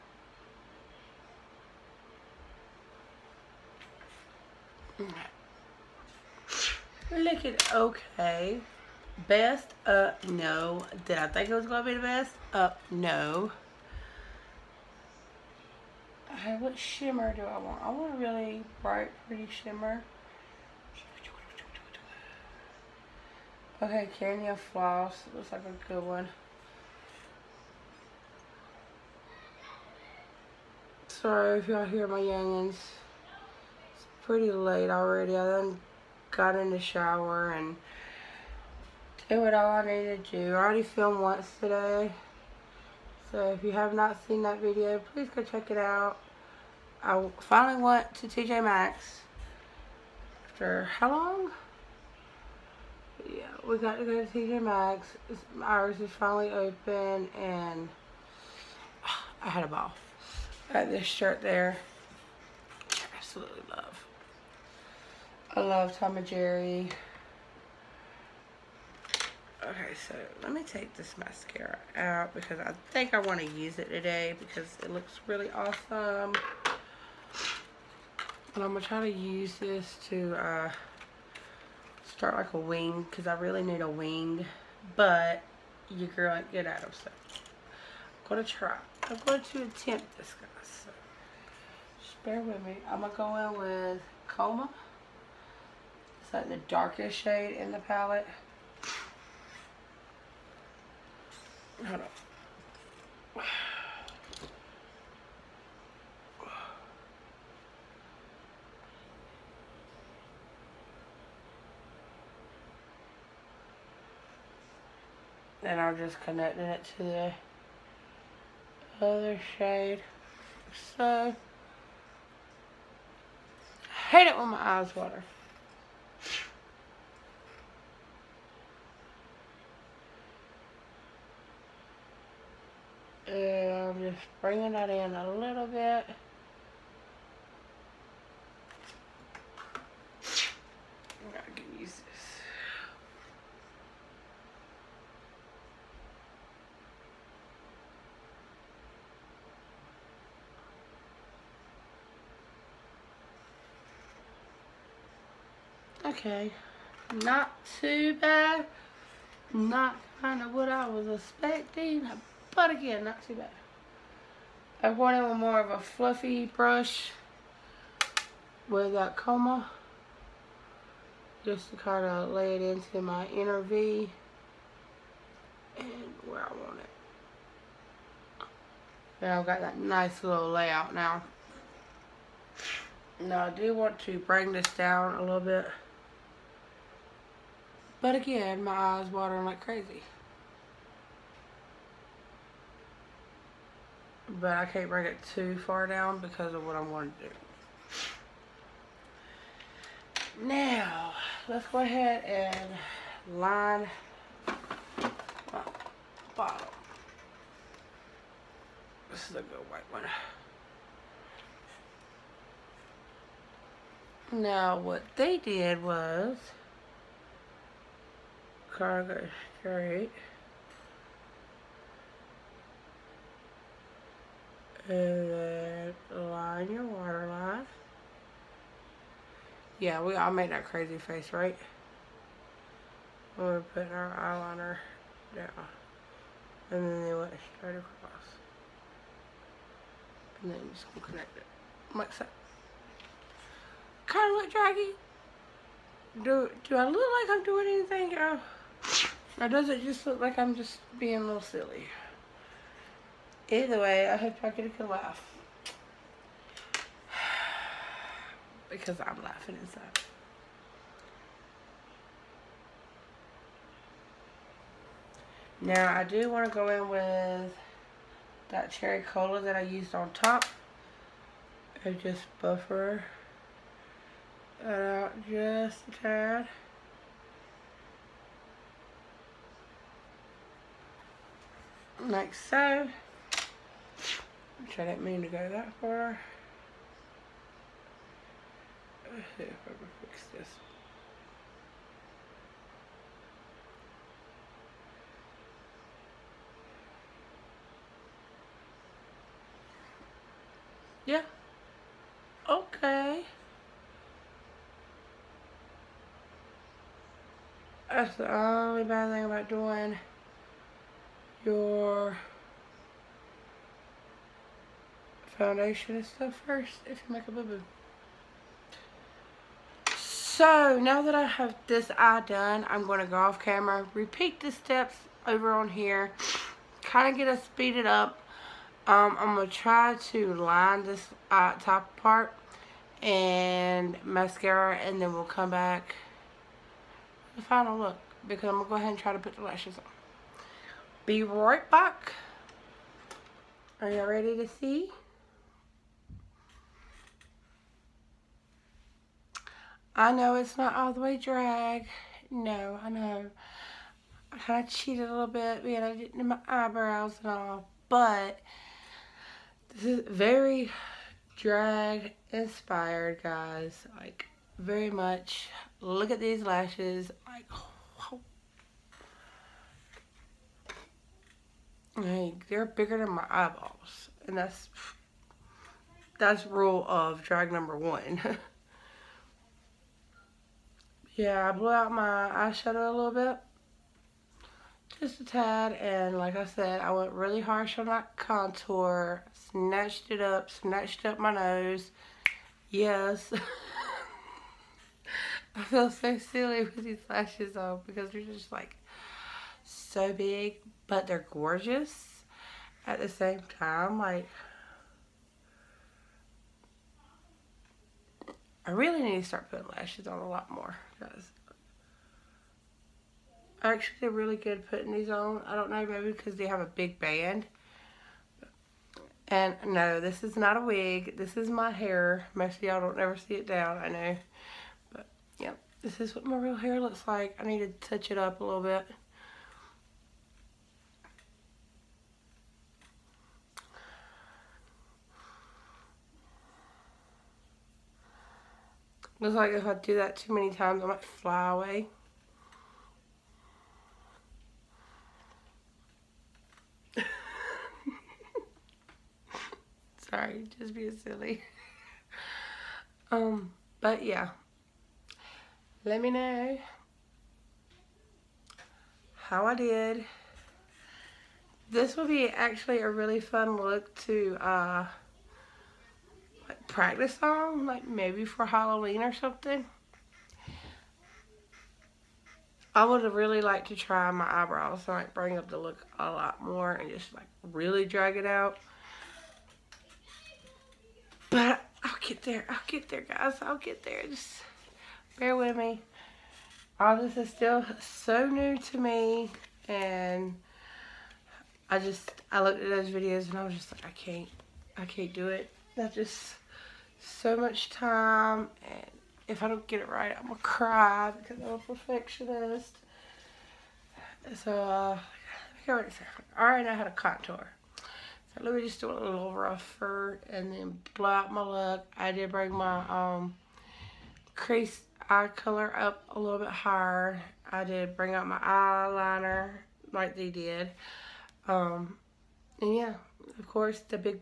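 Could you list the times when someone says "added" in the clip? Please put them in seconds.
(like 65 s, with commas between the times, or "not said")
not said.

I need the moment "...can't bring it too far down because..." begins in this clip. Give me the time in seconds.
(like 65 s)
194 s.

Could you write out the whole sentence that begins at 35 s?
I then got in the shower and did what all I needed to do.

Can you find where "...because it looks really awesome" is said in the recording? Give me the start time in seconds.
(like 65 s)
74 s.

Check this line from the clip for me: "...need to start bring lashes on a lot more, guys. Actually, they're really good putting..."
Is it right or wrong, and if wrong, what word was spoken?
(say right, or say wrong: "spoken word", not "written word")
wrong: "putting", not "bring".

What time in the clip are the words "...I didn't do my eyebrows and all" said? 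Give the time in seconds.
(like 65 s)
355 s.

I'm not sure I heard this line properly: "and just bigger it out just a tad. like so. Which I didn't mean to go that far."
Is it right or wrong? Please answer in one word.
wrong.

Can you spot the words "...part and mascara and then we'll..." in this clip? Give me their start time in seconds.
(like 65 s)
331 s.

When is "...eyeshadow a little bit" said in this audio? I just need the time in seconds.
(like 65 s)
382 s.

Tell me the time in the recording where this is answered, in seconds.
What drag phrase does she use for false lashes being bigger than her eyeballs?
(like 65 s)
376 s.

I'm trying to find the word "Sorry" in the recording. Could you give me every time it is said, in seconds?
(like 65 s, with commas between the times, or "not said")
31 s, 450 s.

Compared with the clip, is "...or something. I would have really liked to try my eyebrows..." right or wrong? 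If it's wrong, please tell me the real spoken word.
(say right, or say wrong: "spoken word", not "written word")
right.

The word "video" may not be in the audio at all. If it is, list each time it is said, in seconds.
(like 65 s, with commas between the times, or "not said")
44 s, 492 s.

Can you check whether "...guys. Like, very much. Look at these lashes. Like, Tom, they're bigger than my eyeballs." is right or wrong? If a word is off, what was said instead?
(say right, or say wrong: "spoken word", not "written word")
wrong: "Like", not "Tom".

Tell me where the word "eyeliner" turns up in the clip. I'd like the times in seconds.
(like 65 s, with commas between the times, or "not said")
234 s, 518 s.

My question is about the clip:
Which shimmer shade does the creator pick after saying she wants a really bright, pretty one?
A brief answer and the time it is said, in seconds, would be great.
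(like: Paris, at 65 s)
Kenya Floss, at 24 s.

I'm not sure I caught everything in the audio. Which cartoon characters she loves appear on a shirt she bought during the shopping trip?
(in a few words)
Tom and Jerry.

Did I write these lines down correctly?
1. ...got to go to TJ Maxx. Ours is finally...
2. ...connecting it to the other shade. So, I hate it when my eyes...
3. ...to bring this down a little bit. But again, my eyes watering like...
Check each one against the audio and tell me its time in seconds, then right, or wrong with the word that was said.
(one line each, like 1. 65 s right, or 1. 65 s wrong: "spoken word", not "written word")
1. 53 s right
2. 116 s right
3. 183 s right.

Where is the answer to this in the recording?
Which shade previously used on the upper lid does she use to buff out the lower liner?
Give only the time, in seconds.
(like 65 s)
268 s.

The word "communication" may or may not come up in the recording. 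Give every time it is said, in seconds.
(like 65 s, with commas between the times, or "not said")
not said.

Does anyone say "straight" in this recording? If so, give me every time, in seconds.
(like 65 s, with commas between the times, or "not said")
219 s, 237 s.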